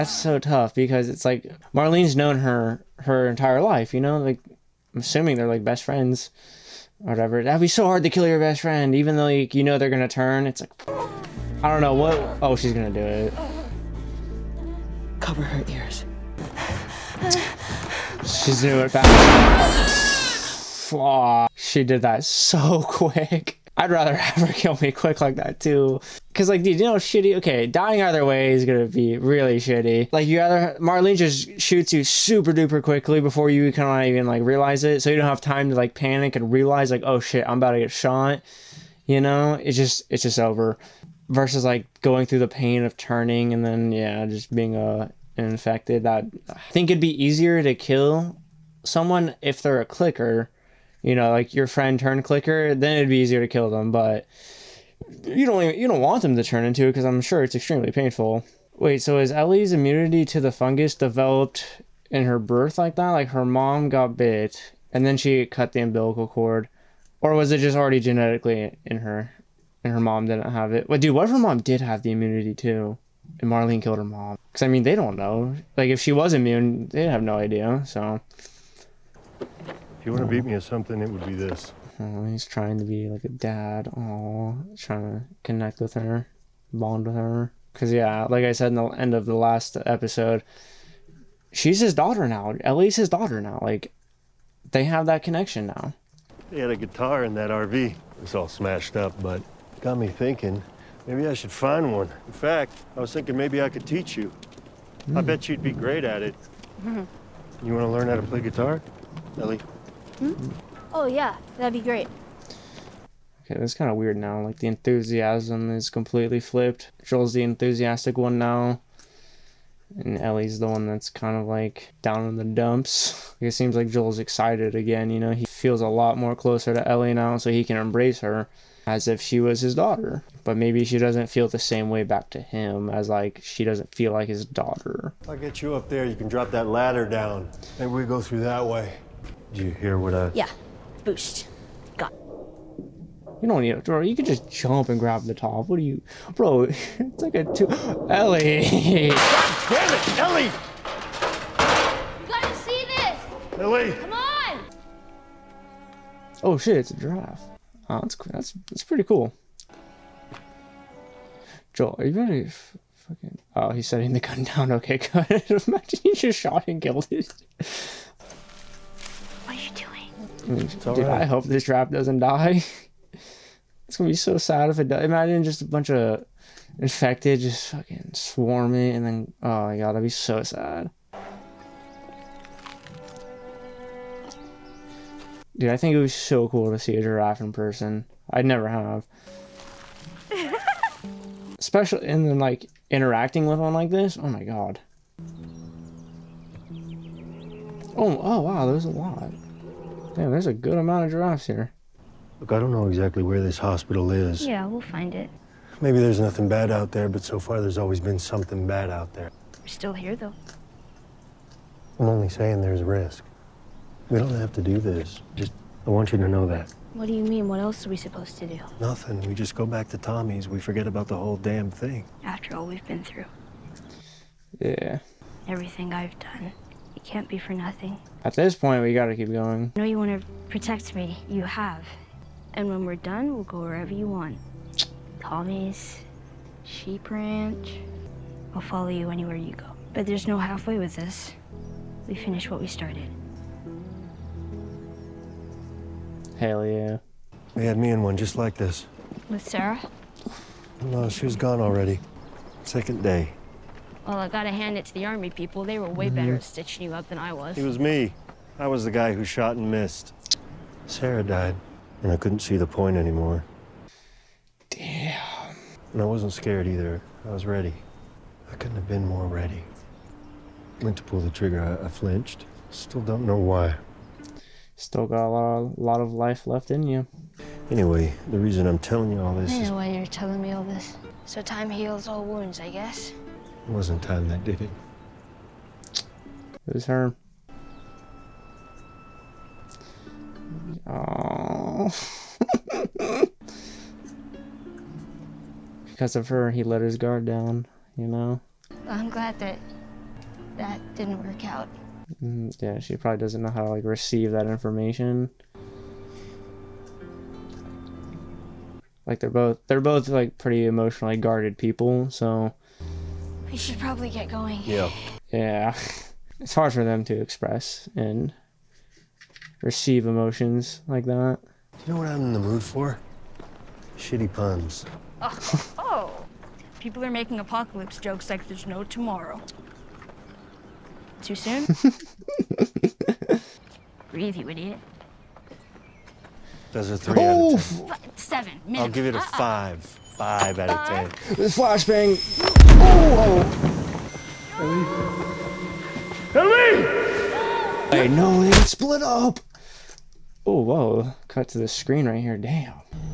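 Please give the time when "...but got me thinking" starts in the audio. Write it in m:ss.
1:39.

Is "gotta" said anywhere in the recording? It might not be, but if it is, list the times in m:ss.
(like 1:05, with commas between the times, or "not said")
2:32, 3:48, 4:14.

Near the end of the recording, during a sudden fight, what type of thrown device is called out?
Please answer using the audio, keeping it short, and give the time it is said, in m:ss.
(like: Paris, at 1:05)
Flashbang, at 5:41.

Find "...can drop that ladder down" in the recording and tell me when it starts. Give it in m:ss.
2:16.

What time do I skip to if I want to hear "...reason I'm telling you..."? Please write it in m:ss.
4:38.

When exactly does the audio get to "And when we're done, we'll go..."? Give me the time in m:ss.
3:52.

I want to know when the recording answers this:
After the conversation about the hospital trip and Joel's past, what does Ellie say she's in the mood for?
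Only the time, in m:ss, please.
5:23.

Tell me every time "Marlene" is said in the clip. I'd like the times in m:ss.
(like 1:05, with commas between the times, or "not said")
0:01, 0:30, 1:13.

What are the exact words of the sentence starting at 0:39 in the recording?
You know, it's just it's just over.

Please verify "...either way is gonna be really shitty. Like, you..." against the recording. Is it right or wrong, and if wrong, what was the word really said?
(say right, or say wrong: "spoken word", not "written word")
right.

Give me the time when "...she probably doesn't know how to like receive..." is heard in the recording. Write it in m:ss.
5:02.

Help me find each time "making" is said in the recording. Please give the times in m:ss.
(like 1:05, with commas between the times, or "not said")
5:27.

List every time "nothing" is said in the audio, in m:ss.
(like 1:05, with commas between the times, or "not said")
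3:26, 3:38, 3:47.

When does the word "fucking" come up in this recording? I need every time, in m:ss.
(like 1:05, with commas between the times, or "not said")
2:42, 2:57.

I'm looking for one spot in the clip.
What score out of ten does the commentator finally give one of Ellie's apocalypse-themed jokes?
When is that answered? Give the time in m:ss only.
5:40.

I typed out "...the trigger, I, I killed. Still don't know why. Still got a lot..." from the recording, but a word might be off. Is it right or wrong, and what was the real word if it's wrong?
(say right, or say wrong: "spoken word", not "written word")
wrong: "flinched", not "killed".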